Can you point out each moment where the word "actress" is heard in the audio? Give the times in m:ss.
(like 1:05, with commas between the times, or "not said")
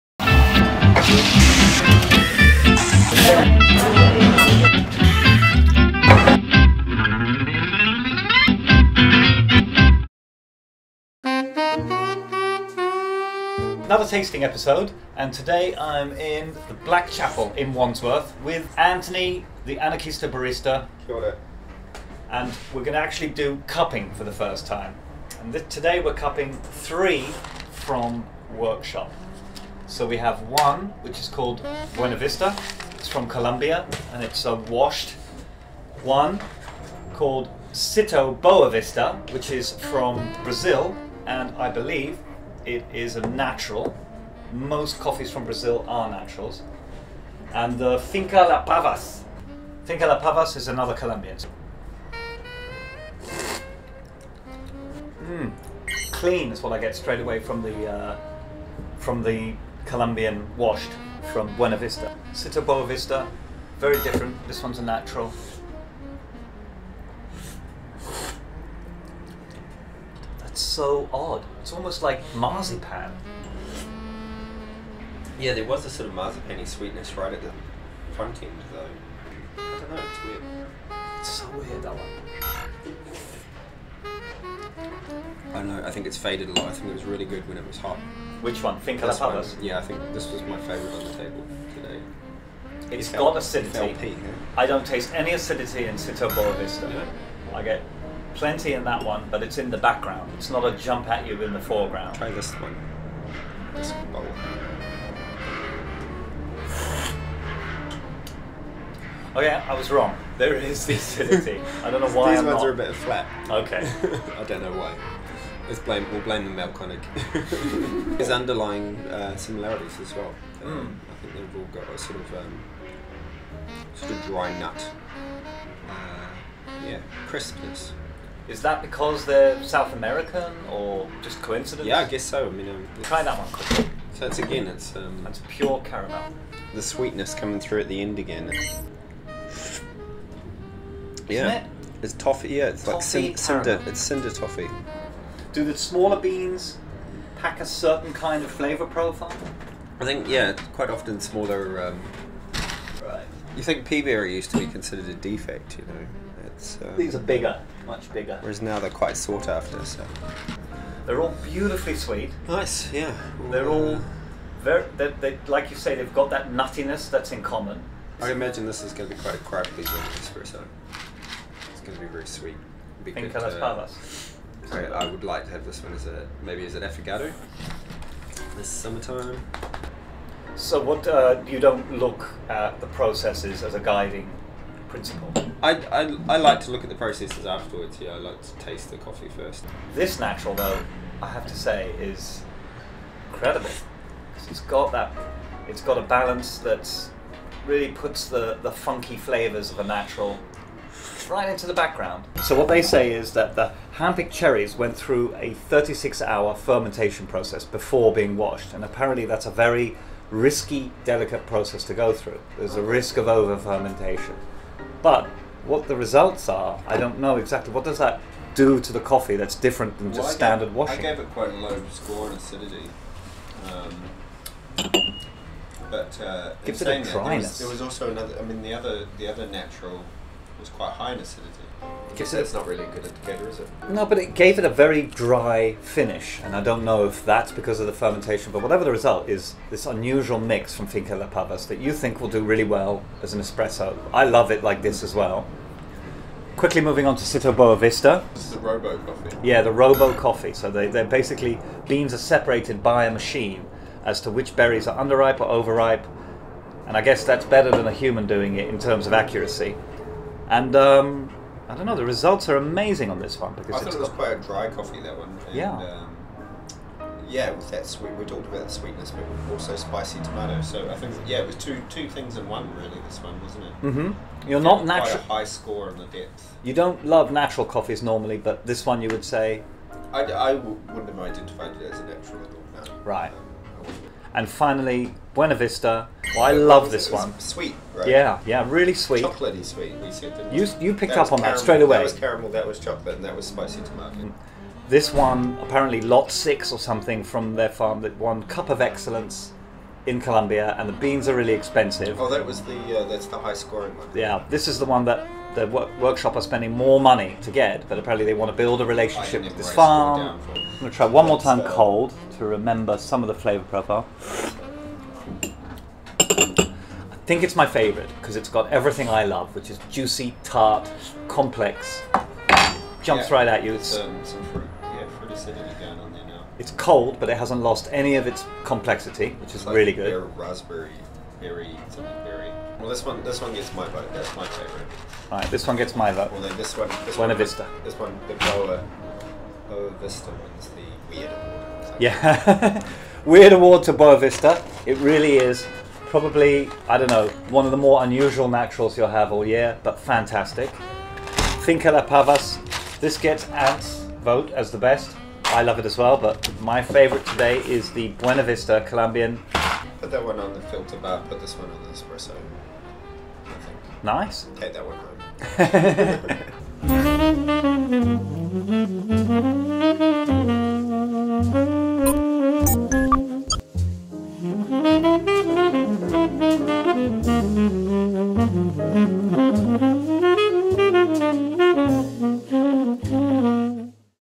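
not said.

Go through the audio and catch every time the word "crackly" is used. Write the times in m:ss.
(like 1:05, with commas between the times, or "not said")
2:49.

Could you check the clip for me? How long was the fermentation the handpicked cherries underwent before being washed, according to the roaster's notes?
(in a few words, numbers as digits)
36 hours.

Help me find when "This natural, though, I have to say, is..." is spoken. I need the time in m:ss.
3:09.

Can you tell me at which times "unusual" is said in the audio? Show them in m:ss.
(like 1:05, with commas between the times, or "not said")
3:59, 5:48.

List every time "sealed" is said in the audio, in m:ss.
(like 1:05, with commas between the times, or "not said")
not said.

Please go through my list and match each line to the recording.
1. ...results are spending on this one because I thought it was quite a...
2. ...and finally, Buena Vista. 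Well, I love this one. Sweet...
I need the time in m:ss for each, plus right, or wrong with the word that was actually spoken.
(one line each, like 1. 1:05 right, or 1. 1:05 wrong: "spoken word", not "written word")
1. 4:22 wrong: "amazing", not "spending"
2. 4:44 right.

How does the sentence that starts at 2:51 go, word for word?
It's going to be very sweet.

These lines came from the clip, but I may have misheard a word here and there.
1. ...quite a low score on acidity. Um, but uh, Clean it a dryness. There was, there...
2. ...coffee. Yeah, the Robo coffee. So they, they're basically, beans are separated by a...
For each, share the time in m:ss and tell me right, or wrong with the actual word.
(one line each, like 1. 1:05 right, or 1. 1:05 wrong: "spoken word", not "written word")
1. 3:41 wrong: "Gives", not "Clean"
2. 4:08 right.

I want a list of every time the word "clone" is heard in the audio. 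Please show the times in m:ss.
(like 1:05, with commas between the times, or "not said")
not said.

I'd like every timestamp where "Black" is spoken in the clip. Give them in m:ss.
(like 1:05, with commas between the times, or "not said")
0:16.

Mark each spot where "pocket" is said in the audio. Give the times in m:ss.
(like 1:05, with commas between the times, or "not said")
not said.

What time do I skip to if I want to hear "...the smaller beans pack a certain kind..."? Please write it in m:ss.
2:25.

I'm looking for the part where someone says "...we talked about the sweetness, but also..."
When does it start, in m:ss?
4:28.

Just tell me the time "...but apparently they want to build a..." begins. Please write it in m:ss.
5:07.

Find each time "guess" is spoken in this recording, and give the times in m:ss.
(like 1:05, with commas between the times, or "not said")
2:12, 4:17.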